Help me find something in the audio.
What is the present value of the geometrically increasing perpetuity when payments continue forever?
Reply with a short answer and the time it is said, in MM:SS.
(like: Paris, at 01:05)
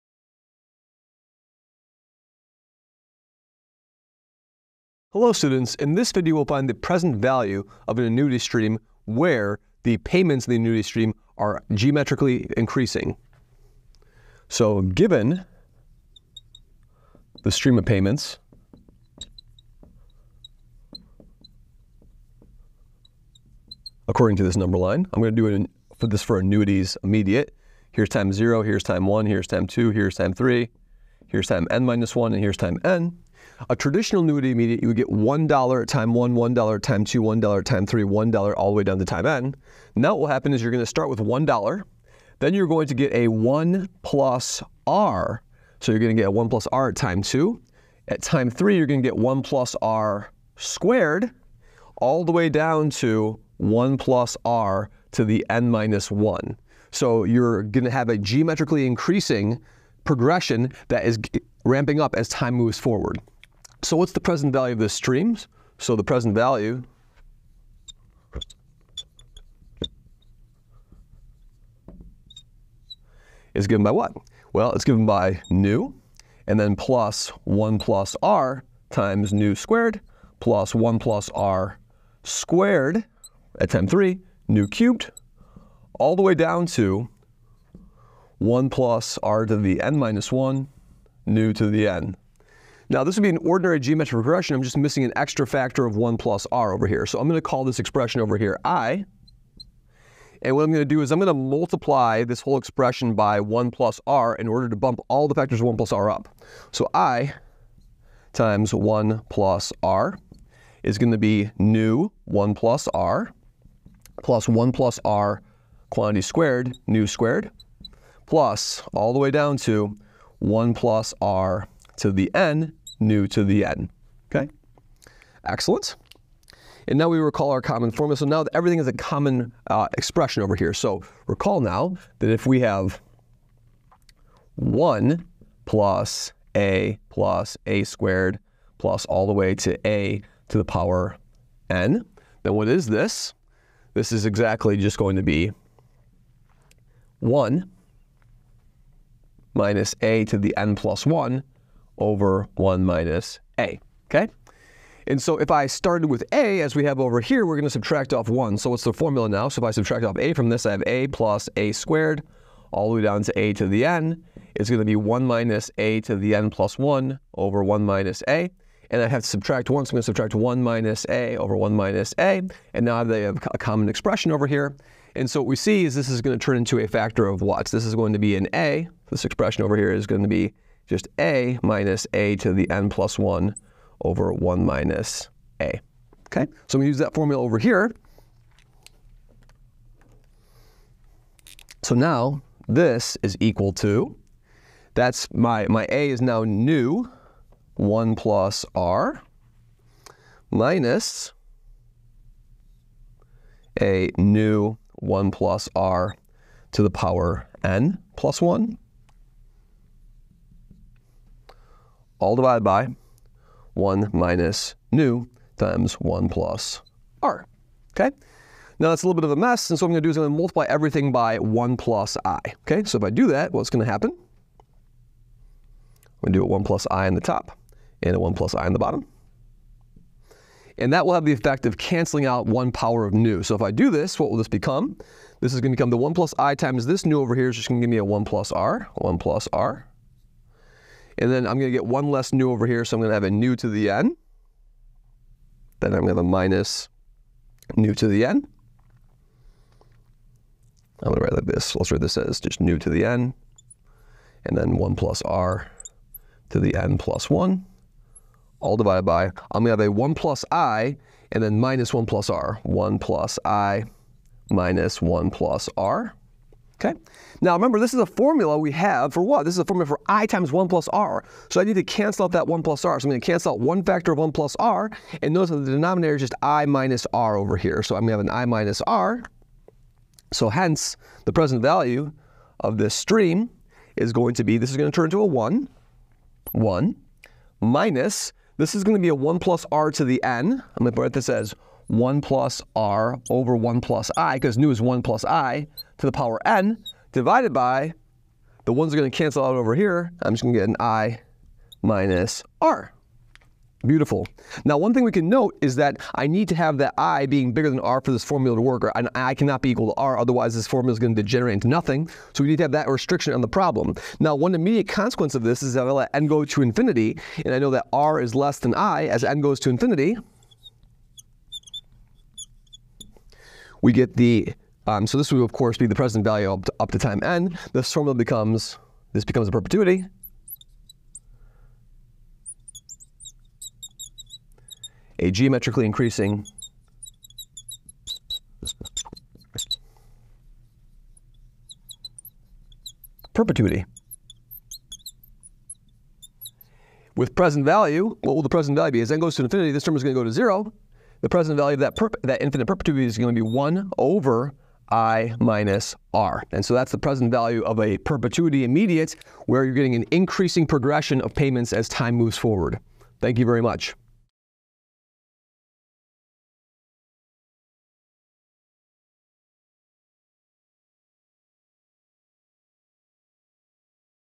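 1 over i minus r, at 05:53.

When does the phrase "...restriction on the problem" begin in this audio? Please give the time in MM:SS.
05:12.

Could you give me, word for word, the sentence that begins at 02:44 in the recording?
It's going to be 1 minus a to the n plus 1 over 1 minus a.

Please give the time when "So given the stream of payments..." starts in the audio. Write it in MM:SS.
00:14.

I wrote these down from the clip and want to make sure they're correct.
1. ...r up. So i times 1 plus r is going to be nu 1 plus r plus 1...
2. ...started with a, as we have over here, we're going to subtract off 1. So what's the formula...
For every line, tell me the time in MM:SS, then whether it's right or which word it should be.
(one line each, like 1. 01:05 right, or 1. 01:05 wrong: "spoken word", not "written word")
1. 01:45 right
2. 02:35 right.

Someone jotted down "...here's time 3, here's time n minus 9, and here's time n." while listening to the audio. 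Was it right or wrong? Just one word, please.
wrong.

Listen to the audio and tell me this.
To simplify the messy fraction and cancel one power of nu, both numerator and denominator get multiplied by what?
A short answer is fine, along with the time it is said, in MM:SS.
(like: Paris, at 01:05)
1 plus i, at 03:40.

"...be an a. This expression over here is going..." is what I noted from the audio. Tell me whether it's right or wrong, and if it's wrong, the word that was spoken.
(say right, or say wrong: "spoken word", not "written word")
right.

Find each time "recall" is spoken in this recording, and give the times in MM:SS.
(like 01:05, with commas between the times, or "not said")
02:07, 02:11.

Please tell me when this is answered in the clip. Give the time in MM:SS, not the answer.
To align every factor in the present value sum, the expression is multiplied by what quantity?
01:41.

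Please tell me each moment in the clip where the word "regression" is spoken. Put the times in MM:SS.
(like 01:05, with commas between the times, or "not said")
01:34.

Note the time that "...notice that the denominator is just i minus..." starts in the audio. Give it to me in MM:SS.
04:35.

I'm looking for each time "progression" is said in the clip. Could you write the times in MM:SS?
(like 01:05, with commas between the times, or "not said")
01:00, 06:00.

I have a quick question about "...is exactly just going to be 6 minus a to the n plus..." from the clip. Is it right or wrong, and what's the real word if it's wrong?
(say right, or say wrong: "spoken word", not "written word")
wrong: "1", not "6".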